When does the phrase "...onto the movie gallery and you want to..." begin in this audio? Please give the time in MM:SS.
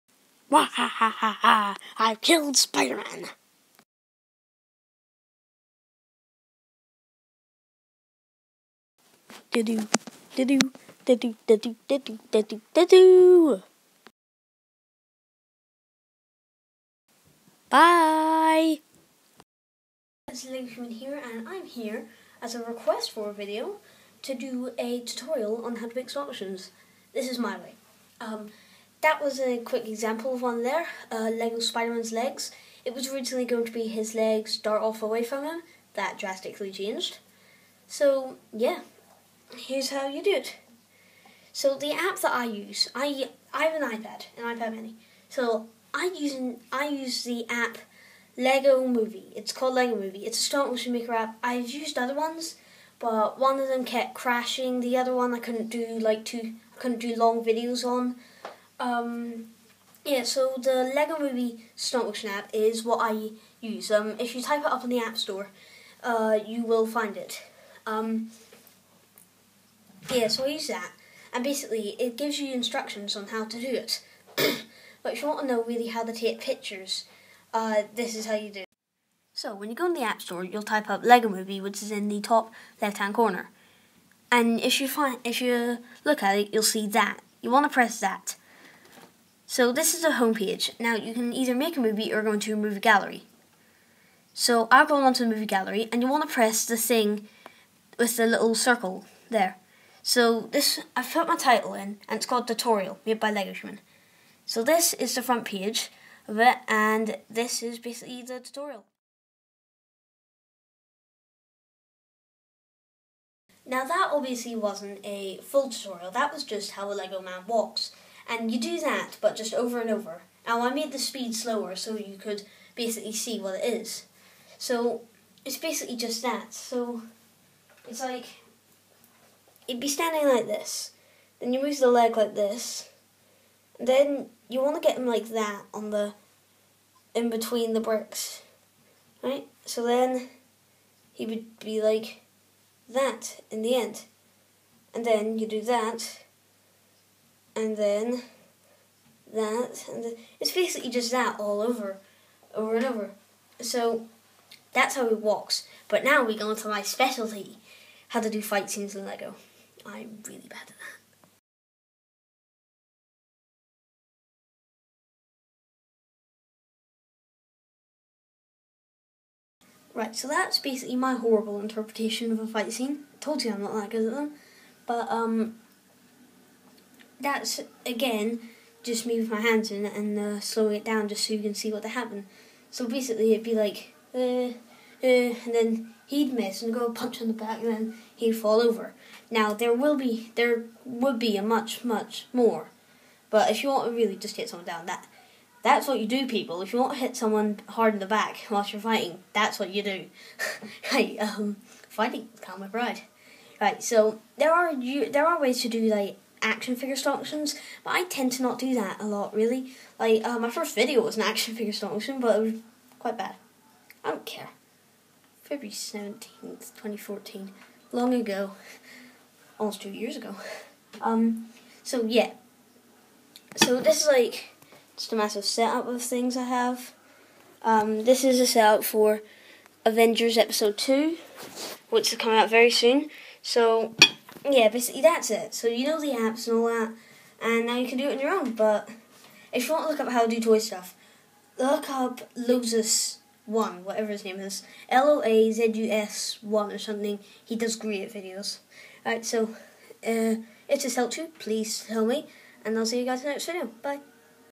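01:35.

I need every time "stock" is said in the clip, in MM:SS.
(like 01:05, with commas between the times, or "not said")
03:26, 03:31.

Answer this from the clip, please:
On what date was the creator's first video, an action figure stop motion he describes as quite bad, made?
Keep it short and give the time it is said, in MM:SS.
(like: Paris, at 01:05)
February 17th, 2014, at 03:35.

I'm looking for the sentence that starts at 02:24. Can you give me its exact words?
And then you do that, and then that, and it's basically just that all over, over and over.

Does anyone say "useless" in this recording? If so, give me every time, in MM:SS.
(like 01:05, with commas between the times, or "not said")
not said.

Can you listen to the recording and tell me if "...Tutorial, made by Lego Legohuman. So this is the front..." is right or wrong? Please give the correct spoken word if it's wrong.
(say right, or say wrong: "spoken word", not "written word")
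right.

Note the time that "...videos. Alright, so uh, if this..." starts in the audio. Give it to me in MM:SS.
04:08.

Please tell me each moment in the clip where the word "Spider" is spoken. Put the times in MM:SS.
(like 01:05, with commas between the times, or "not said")
00:02, 00:31.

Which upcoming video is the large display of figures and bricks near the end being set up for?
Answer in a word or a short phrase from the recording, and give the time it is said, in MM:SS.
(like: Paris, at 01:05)
Avengers Episode 2, at 03:49.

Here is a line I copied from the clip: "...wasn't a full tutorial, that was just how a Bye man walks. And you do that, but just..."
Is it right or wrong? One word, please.
wrong.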